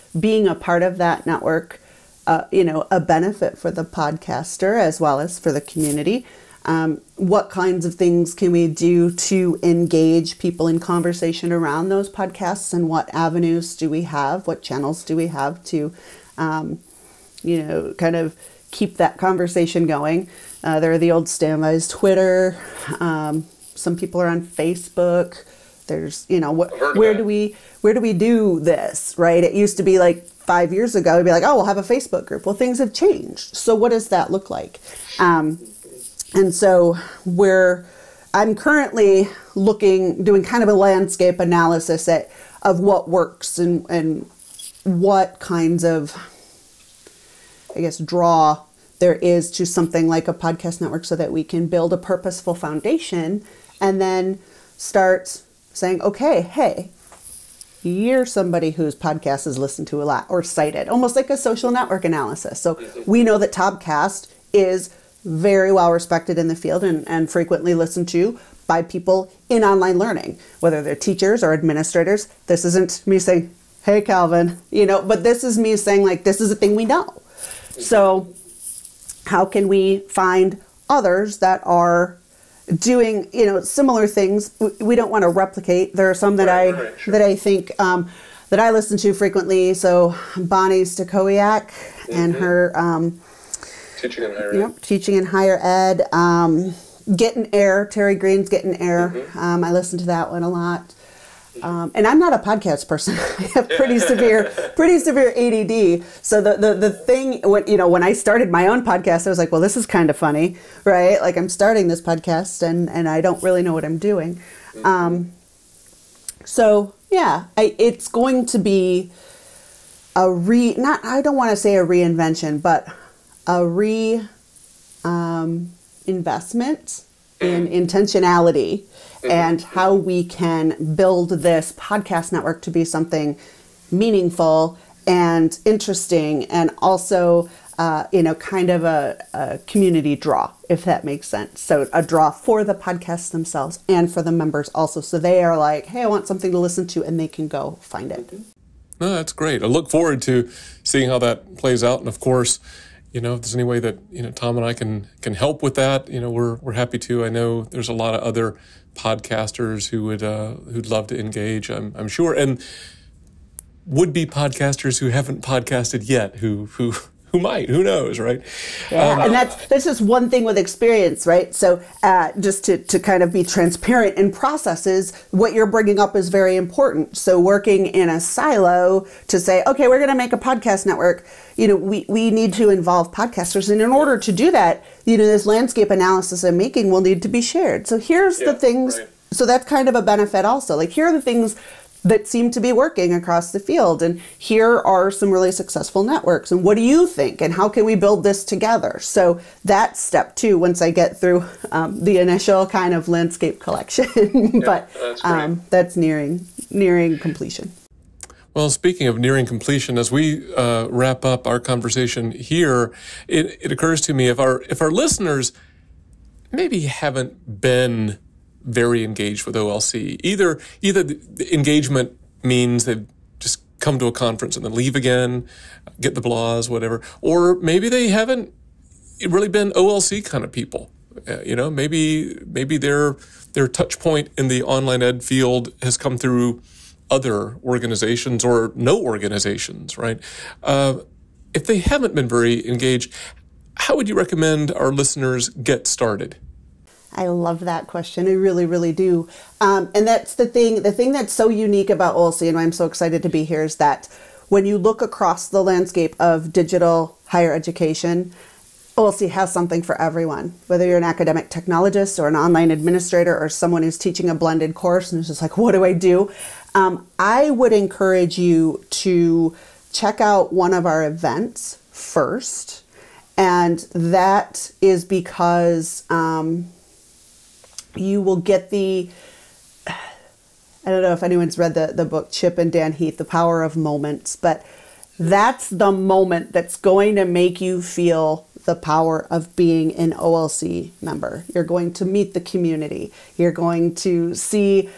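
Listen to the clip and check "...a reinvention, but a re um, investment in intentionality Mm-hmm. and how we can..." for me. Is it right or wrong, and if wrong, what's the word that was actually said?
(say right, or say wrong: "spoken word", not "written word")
right.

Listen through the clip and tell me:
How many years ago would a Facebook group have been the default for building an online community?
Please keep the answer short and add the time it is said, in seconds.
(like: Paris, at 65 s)
5 years ago, at 30 s.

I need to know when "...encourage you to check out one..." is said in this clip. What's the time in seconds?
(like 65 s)
267 s.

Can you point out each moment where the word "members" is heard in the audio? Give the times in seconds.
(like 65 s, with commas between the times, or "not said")
144 s, 291 s.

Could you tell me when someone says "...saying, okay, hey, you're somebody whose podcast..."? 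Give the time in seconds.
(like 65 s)
55 s.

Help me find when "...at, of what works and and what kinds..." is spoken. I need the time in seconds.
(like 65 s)
42 s.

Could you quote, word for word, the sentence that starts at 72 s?
This isn't me saying, hey, Kelvin, you know, but this is me saying, like, this is a thing we know.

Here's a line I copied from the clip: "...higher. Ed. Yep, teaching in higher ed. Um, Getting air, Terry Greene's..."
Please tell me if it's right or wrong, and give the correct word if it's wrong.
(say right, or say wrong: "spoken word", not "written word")
right.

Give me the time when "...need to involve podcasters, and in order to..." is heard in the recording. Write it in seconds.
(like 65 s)
182 s.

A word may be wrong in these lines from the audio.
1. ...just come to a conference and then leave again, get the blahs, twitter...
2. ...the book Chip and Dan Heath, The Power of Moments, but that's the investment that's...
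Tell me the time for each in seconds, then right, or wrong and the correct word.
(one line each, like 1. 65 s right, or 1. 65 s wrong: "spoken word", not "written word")
1. 223 s wrong: "whatever", not "twitter"
2. 281 s wrong: "moment", not "investment".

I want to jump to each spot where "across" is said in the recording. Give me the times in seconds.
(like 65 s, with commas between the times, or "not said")
193 s, 255 s.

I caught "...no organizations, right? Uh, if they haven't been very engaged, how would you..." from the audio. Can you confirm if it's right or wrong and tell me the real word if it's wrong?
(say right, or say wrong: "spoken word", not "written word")
right.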